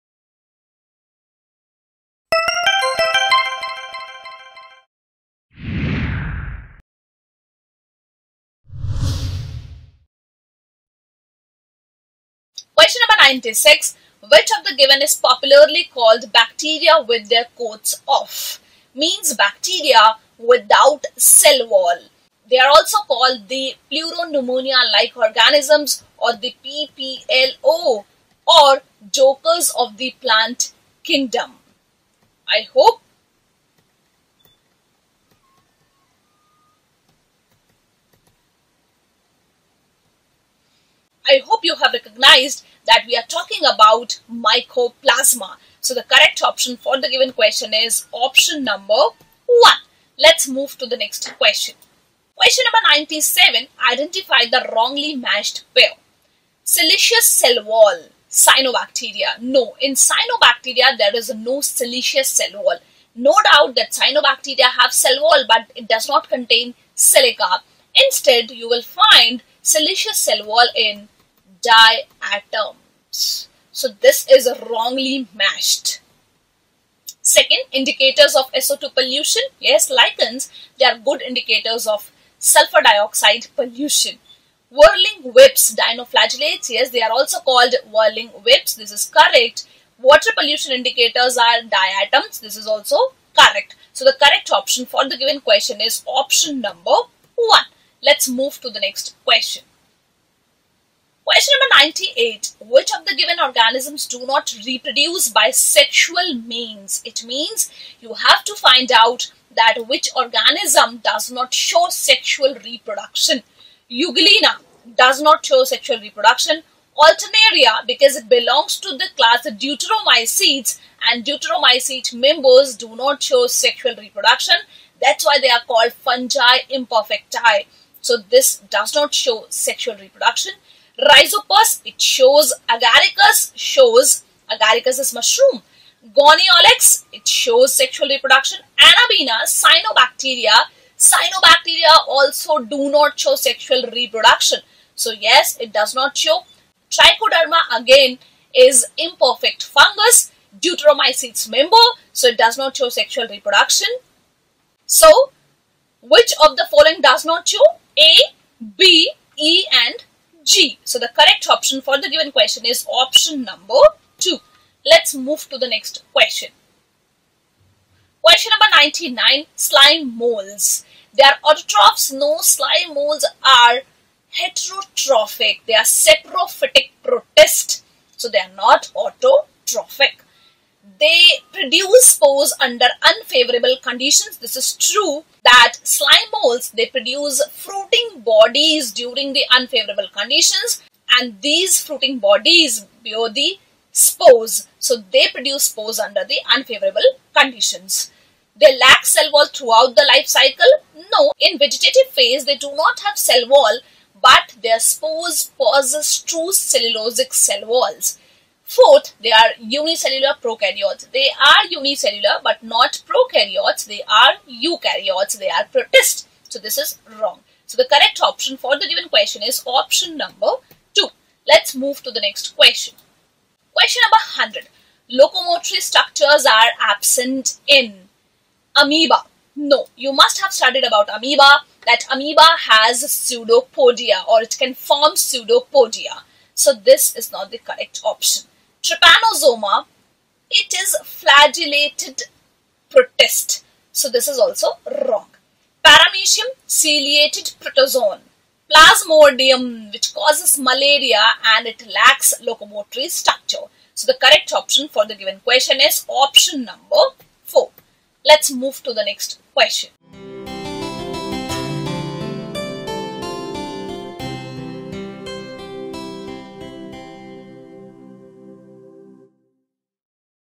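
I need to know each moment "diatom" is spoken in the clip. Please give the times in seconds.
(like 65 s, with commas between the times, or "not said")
71 s, 91 s.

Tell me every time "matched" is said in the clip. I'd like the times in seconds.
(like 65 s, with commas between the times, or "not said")
55 s, 75 s.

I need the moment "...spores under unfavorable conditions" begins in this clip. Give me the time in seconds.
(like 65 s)
182 s.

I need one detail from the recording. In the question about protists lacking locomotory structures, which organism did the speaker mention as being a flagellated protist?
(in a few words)
Trypanosoma.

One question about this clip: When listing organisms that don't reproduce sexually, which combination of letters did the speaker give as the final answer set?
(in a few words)
A, B, E and G.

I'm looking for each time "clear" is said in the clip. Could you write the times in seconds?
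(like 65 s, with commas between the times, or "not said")
not said.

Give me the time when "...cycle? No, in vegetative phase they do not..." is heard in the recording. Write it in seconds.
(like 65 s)
200 s.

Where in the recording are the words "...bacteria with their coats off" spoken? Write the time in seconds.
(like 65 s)
16 s.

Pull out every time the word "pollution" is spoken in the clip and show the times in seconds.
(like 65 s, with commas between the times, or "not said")
78 s, 83 s, 90 s.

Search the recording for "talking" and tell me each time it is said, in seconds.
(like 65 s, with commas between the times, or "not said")
43 s.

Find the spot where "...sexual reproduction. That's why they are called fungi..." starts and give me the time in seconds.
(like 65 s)
123 s.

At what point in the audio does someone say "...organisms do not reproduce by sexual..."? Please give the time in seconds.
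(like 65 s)
103 s.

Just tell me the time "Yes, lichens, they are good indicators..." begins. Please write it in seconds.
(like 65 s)
79 s.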